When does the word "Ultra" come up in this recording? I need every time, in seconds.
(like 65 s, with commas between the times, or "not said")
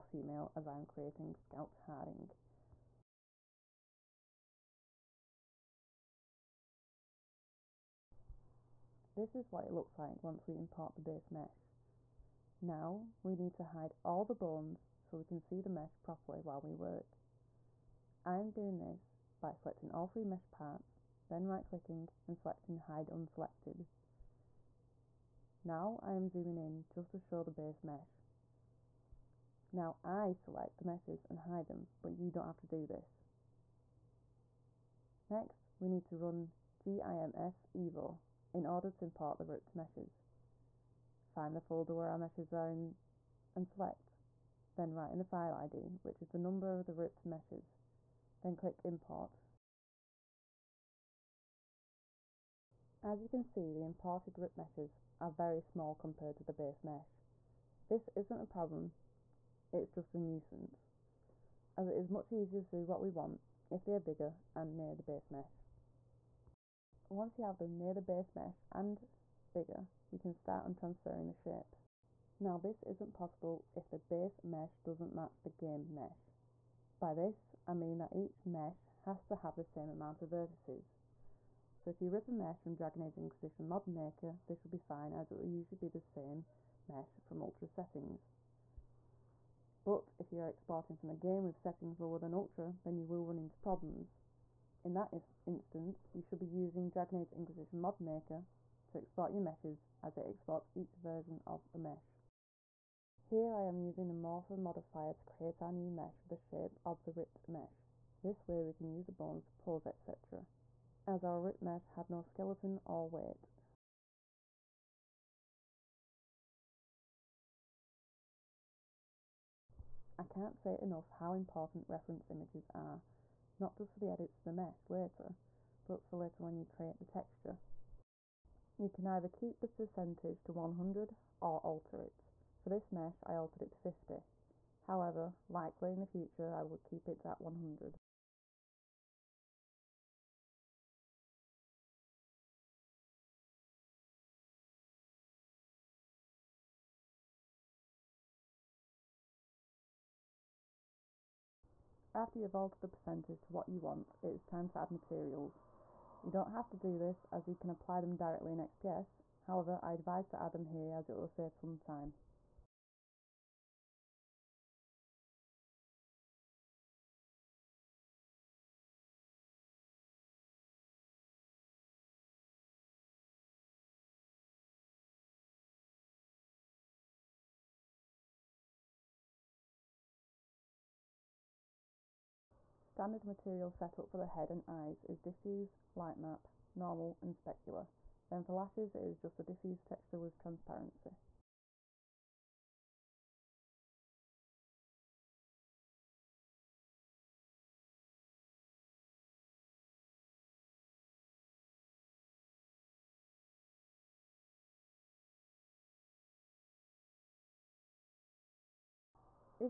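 87 s, 92 s.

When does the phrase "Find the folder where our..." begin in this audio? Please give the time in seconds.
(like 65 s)
41 s.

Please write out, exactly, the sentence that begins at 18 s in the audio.
I am doing this by selecting all three mesh parts, then right clicking and selecting hide unselected.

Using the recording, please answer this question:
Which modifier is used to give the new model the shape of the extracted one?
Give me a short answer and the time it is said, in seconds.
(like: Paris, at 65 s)
Morpher, at 104 s.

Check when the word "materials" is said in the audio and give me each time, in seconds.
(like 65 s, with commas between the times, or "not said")
154 s, 183 s.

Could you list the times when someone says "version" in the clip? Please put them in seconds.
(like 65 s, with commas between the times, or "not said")
101 s.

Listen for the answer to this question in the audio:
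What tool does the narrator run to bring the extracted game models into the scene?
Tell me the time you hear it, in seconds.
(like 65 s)
36 s.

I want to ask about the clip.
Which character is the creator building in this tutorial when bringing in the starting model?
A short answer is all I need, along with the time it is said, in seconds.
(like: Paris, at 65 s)
Scout Harding, at 1 s.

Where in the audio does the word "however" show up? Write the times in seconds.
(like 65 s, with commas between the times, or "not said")
134 s, 159 s.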